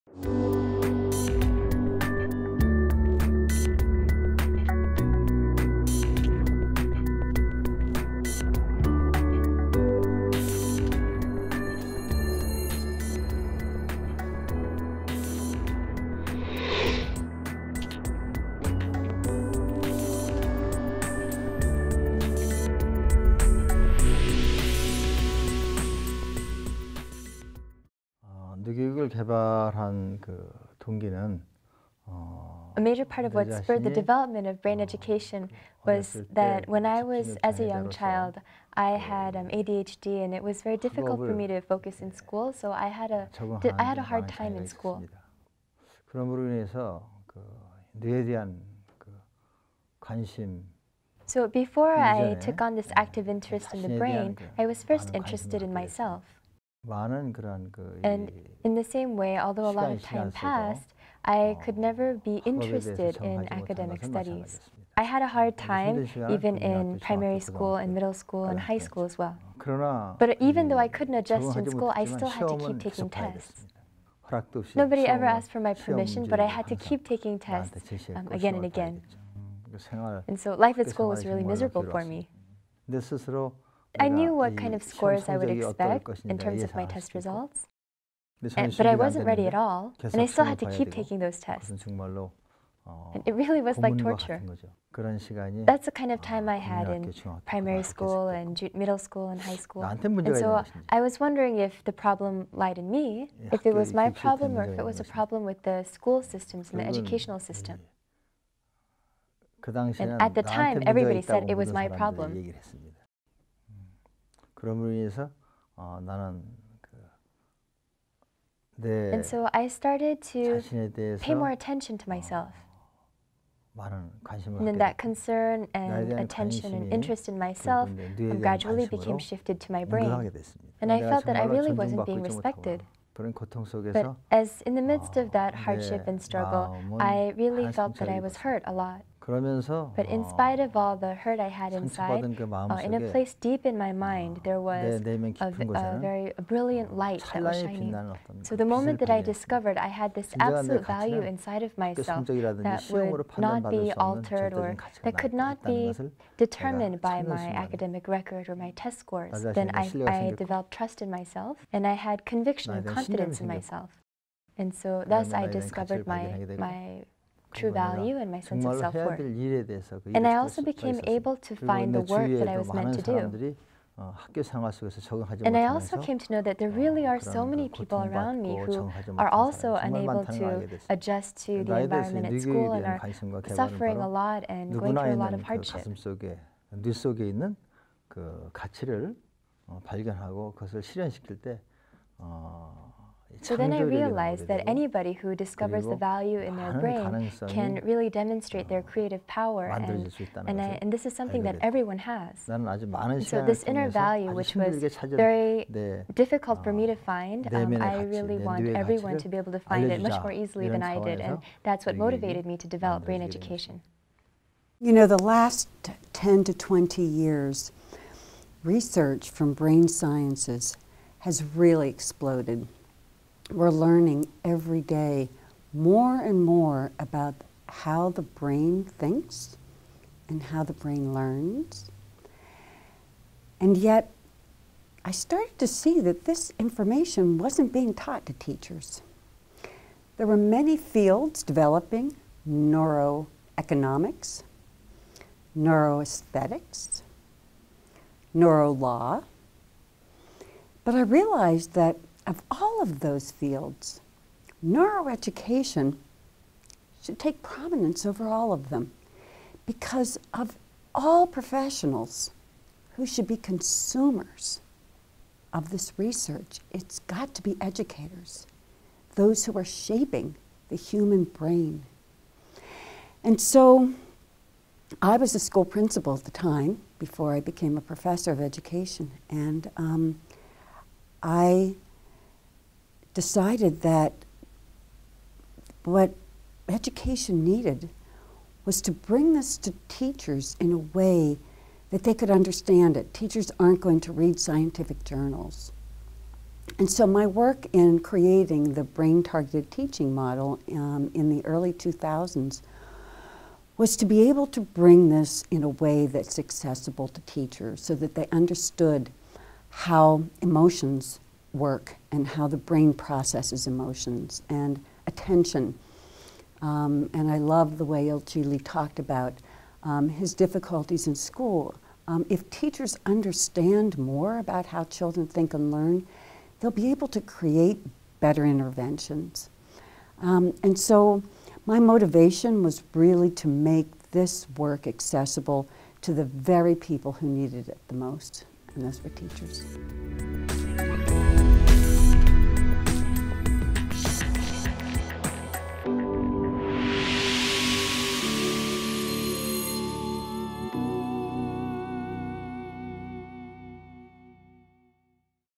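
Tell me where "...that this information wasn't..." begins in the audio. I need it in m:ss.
3:56.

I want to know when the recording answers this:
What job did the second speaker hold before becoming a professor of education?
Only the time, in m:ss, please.
4:35.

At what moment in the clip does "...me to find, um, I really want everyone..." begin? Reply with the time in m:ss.
3:26.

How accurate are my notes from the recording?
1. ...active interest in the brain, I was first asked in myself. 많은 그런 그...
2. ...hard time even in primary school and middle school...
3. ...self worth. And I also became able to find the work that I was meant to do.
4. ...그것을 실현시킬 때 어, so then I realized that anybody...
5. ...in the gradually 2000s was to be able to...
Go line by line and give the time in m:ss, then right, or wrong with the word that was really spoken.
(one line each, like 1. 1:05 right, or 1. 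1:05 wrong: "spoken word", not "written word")
1. 0:52 wrong: "interested", not "asked"
2. 1:05 right
3. 2:48 right
4. 3:10 right
5. 5:01 wrong: "early", not "gradually".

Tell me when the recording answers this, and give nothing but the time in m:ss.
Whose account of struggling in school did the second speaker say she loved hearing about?
5:18.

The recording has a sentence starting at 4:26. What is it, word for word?
It's got to be educators, those who are shaping the human brain.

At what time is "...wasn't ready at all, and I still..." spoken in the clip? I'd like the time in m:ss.
1:28.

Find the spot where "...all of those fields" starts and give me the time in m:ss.
4:12.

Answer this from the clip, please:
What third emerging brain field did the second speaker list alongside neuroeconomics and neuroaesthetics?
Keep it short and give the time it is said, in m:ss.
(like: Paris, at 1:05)
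neurolaw, at 4:08.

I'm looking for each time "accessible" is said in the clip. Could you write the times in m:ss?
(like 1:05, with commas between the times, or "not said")
5:06, 5:34.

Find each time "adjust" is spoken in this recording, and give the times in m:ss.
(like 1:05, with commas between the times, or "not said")
1:11, 3:00.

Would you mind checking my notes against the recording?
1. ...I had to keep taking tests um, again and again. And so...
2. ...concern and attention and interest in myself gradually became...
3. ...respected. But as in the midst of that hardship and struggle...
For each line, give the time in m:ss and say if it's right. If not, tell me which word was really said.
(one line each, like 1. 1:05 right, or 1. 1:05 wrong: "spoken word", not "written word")
1. 1:16 right
2. 2:04 right
3. 2:12 right.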